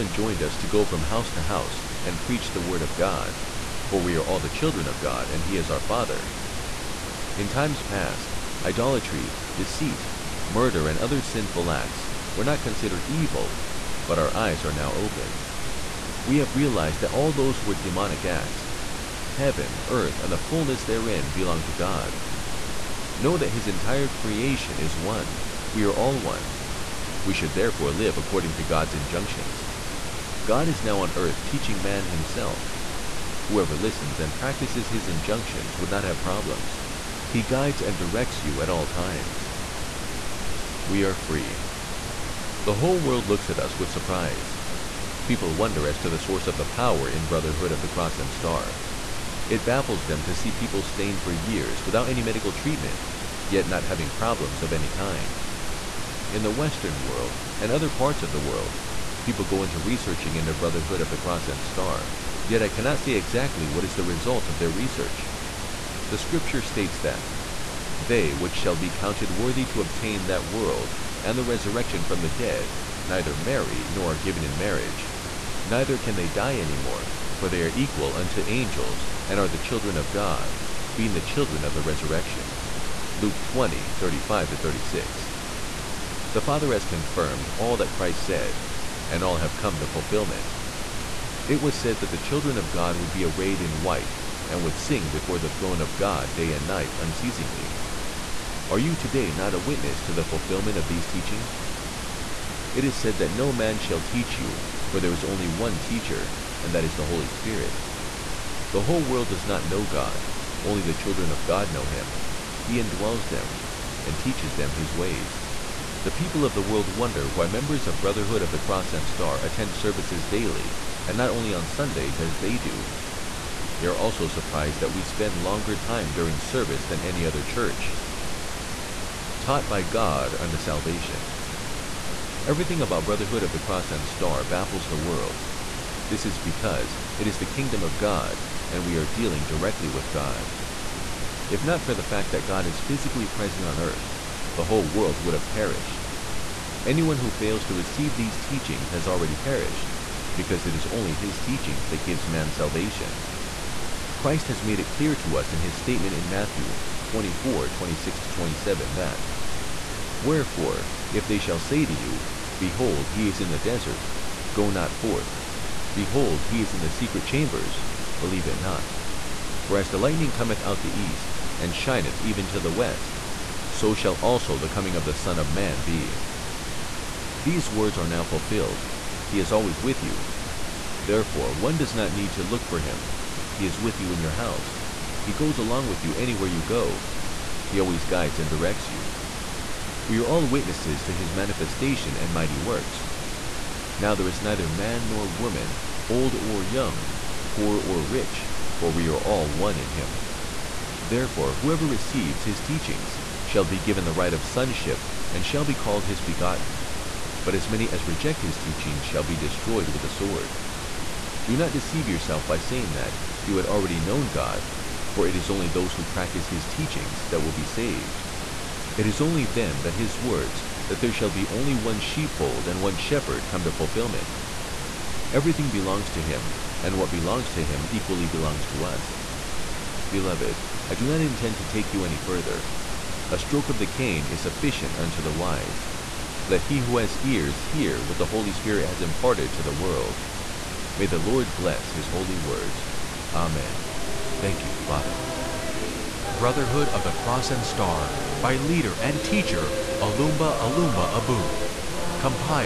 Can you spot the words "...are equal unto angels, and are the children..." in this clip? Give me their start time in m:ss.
1:17.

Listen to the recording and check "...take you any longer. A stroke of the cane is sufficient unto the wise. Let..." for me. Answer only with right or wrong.
wrong.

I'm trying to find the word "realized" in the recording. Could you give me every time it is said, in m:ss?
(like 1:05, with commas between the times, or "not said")
0:16.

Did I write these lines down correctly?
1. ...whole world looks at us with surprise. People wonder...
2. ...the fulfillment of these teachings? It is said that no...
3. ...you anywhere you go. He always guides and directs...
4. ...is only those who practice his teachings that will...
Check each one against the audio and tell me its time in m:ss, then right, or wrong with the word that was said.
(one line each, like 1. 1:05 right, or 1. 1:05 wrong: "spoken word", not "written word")
1. 0:42 right
2. 1:40 right
3. 3:06 right
4. 3:35 right.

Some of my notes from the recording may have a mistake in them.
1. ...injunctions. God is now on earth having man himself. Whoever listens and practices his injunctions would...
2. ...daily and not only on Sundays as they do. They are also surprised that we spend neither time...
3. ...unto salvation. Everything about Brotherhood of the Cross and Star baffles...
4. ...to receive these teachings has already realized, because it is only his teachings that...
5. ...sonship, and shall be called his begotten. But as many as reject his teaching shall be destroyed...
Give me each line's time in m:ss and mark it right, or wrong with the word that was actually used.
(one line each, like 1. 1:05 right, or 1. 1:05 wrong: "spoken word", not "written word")
1. 0:28 wrong: "teaching", not "having"
2. 2:00 wrong: "longer", not "neither"
3. 2:10 right
4. 2:27 wrong: "perished", not "realized"
5. 3:24 right.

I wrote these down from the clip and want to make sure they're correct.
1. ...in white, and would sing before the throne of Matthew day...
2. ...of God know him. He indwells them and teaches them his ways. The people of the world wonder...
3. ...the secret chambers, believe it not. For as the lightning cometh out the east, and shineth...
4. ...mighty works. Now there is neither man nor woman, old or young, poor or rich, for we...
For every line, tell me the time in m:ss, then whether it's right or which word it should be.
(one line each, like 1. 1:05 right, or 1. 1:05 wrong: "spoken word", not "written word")
1. 1:33 wrong: "God", not "Matthew"
2. 1:51 right
3. 2:46 right
4. 3:12 right.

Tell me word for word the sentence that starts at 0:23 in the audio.
Know that his entire creation is one.